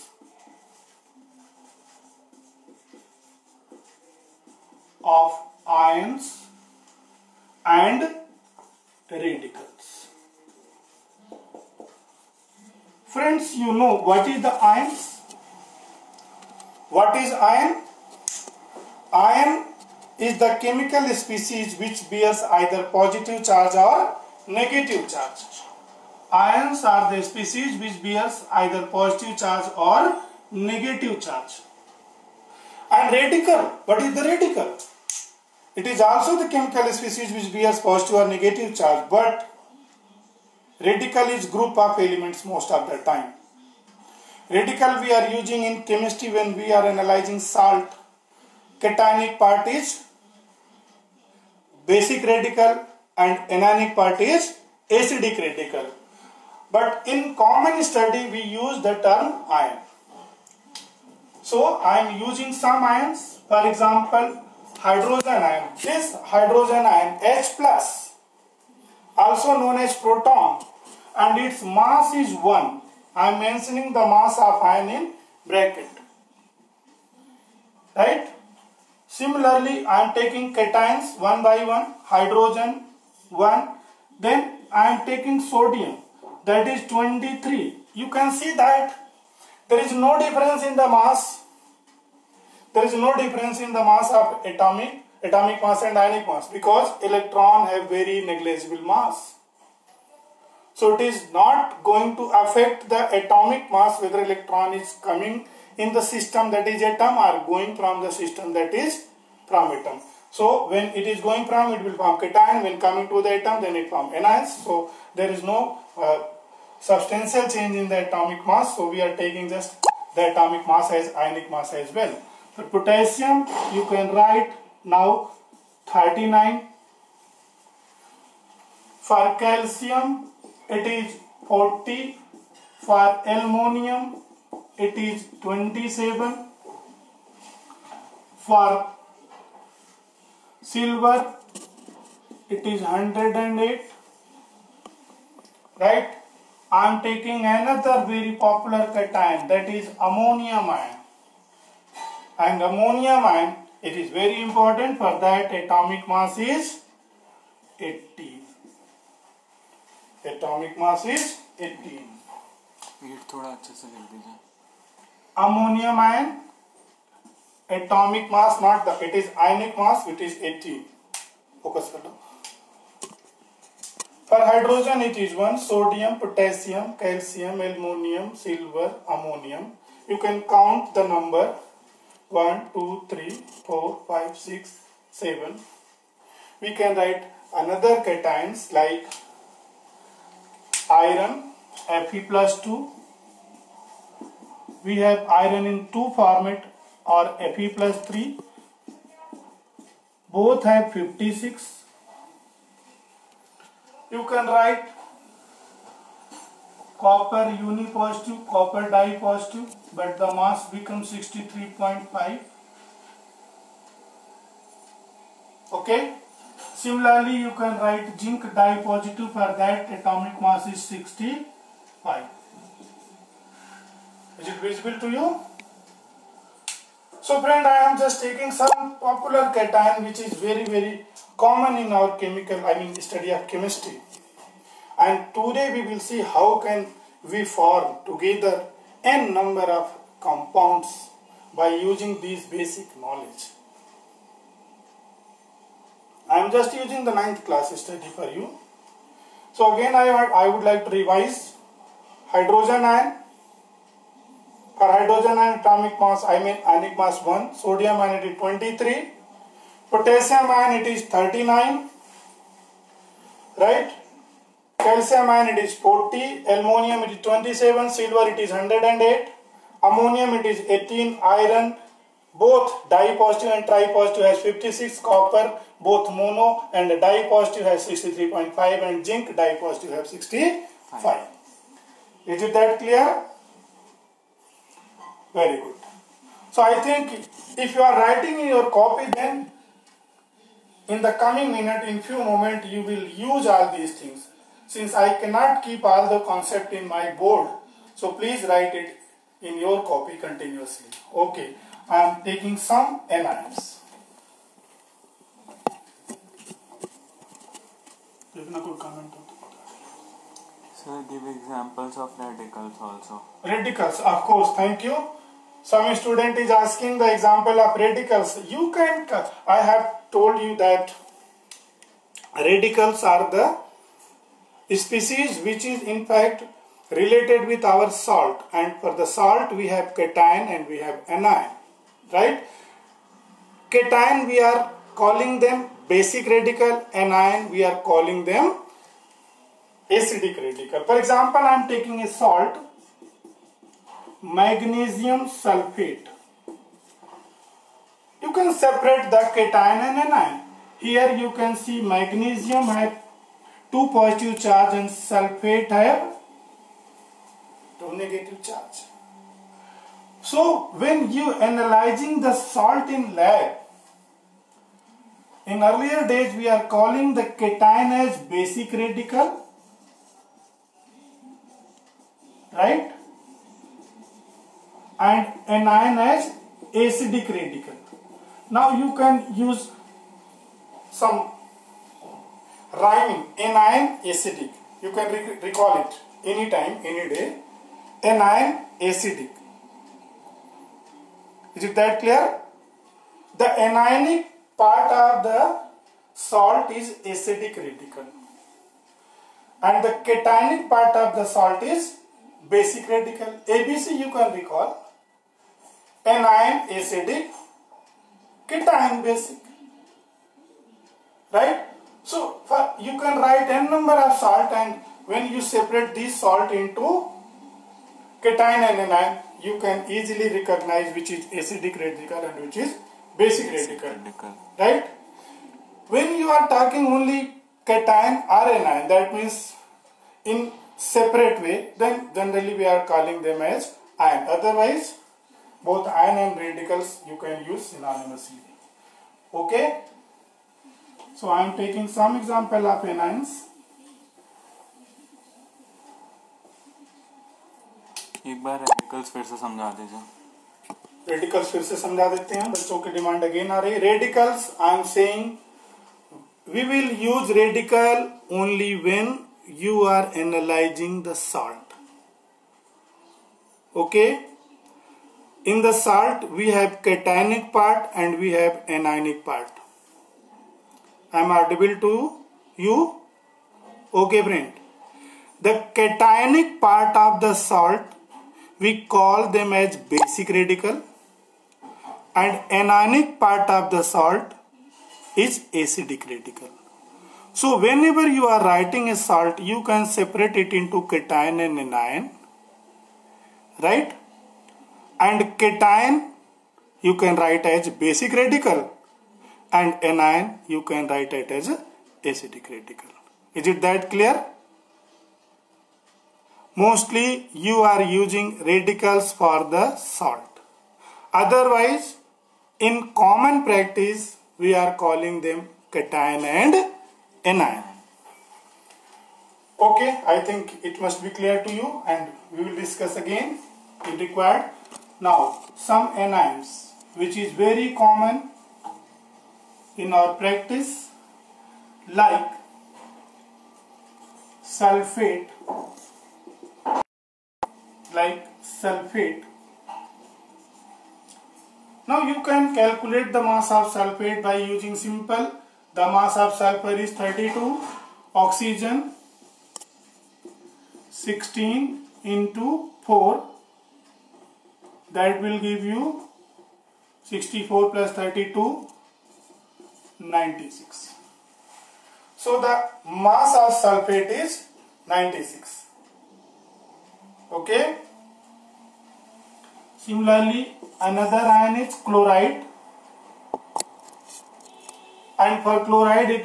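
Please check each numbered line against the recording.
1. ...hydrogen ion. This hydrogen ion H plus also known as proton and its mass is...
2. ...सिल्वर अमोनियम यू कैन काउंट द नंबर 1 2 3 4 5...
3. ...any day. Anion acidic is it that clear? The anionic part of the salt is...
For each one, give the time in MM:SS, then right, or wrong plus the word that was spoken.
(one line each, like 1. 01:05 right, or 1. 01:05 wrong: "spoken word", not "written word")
1. 01:04 right
2. 02:58 right
3. 06:26 right.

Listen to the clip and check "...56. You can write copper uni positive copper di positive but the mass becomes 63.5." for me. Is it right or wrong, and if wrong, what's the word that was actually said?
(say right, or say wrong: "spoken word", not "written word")
right.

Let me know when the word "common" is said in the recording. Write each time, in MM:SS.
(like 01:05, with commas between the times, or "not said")
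00:57, 03:51, 08:32, 08:47.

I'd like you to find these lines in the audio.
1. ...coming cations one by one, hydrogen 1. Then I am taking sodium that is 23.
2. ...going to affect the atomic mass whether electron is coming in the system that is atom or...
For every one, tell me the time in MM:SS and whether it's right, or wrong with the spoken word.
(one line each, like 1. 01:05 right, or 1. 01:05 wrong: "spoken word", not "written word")
1. 01:20 wrong: "taking", not "coming"
2. 01:41 right.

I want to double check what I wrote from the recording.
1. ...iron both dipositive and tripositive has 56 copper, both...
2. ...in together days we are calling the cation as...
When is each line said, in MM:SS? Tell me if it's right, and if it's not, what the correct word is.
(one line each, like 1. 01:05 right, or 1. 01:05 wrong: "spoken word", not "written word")
1. 04:31 right
2. 06:05 wrong: "earlier", not "together".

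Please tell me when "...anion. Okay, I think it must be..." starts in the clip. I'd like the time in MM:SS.
08:37.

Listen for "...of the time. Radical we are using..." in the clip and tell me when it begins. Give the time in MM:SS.
00:42.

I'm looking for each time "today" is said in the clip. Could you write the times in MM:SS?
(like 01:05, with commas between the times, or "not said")
03:55.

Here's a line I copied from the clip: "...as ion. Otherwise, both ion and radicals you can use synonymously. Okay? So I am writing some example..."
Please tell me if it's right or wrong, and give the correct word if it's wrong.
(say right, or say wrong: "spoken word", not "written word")
wrong: "taking", not "writing".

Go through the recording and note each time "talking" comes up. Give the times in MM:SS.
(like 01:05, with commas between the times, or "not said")
07:06.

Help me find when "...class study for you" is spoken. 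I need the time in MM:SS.
04:07.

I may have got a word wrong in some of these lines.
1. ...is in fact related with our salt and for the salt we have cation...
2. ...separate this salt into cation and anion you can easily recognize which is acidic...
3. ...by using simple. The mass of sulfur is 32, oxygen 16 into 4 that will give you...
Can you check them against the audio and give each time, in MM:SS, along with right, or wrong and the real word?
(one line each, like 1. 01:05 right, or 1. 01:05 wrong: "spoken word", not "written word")
1. 05:25 right
2. 06:55 right
3. 09:04 right.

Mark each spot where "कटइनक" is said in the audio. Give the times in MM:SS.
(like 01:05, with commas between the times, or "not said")
07:46, 07:55.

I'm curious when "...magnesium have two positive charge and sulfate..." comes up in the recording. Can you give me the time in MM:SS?
05:51.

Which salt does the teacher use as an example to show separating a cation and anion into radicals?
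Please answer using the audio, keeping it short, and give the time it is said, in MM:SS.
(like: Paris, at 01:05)
magnesium sulfate, at 05:44.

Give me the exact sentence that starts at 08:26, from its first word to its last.
mostly you are using radicals for the salt.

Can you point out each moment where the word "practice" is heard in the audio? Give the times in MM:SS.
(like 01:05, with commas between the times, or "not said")
08:33, 08:50.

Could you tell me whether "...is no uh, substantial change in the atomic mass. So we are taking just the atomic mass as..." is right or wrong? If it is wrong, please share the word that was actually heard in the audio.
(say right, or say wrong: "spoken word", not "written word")
right.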